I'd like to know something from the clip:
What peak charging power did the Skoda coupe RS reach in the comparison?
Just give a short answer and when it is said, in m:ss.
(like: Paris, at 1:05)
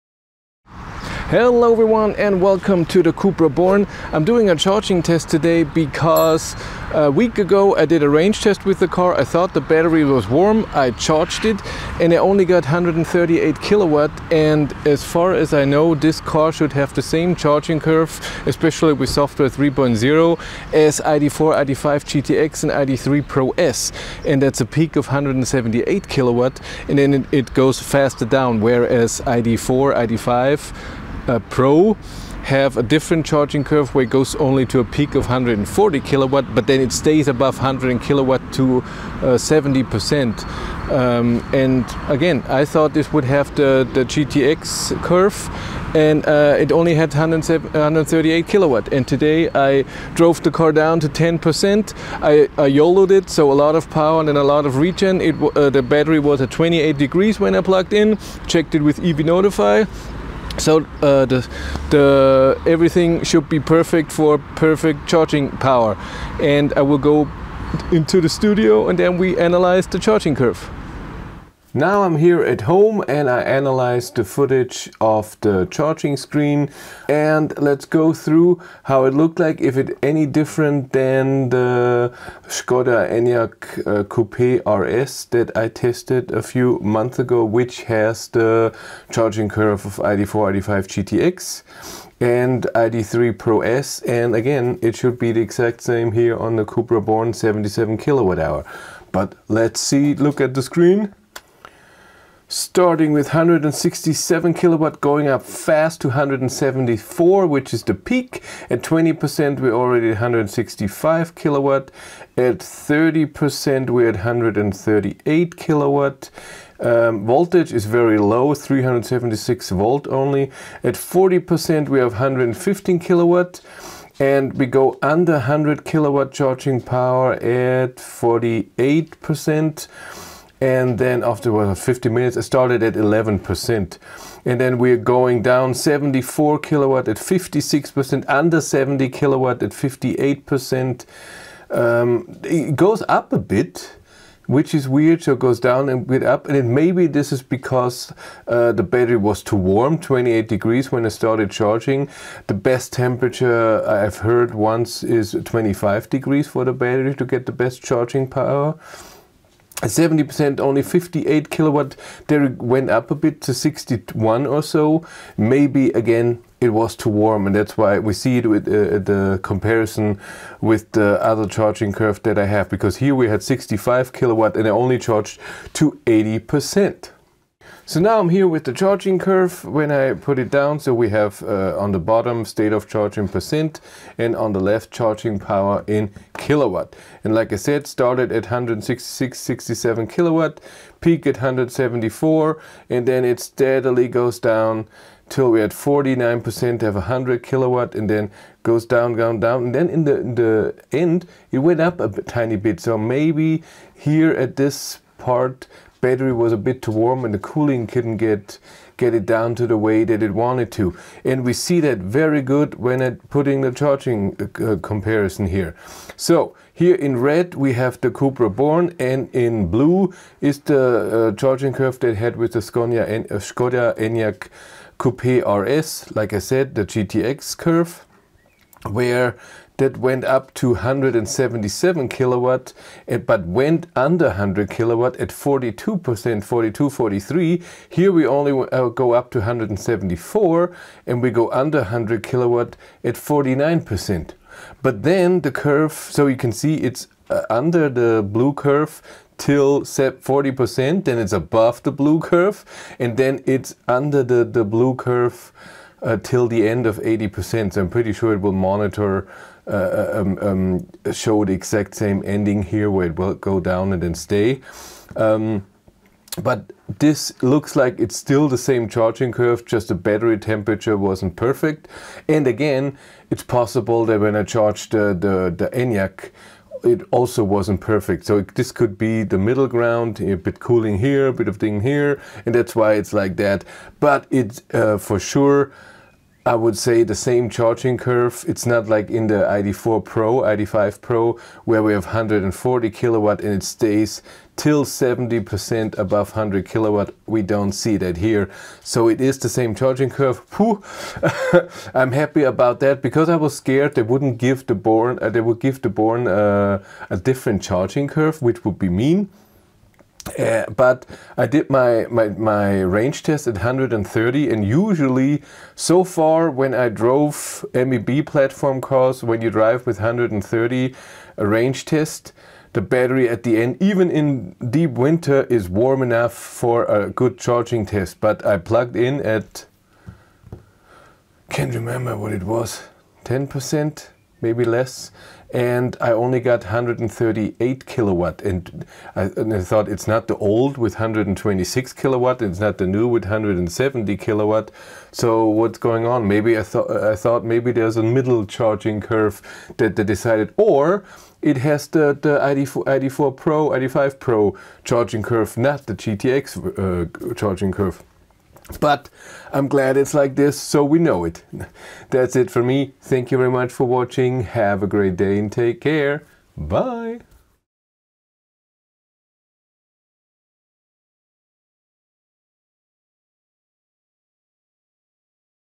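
177 kilowatt, at 3:50.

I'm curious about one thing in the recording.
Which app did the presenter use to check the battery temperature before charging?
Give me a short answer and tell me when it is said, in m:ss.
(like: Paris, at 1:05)
EV Notify, at 0:59.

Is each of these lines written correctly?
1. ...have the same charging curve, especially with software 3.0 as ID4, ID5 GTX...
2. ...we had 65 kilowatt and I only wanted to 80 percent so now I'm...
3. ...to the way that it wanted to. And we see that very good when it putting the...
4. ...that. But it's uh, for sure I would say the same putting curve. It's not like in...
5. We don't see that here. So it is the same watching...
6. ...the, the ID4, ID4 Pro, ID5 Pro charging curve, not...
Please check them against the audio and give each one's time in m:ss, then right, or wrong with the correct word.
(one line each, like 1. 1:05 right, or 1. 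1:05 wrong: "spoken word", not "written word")
1. 0:16 right
2. 2:53 wrong: "charged", not "wanted"
3. 3:29 right
4. 4:43 wrong: "charging", not "putting"
5. 4:57 wrong: "charging", not "watching"
6. 5:51 right.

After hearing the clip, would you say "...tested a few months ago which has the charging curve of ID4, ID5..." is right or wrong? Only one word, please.
right.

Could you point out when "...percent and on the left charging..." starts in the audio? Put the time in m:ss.
3:03.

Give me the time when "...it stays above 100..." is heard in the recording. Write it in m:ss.
0:36.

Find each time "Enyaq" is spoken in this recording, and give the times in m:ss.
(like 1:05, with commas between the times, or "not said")
1:23, 3:43, 4:35.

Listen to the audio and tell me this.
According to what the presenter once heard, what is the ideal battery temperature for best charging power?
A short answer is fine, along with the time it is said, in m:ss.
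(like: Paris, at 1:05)
25 degrees, at 2:35.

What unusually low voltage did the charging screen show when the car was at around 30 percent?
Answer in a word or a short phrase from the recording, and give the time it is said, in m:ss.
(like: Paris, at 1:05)
376 volts, at 1:58.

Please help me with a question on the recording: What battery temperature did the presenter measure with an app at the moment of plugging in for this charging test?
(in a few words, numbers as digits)
28 degrees.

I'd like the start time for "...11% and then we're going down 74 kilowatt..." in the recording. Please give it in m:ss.
2:12.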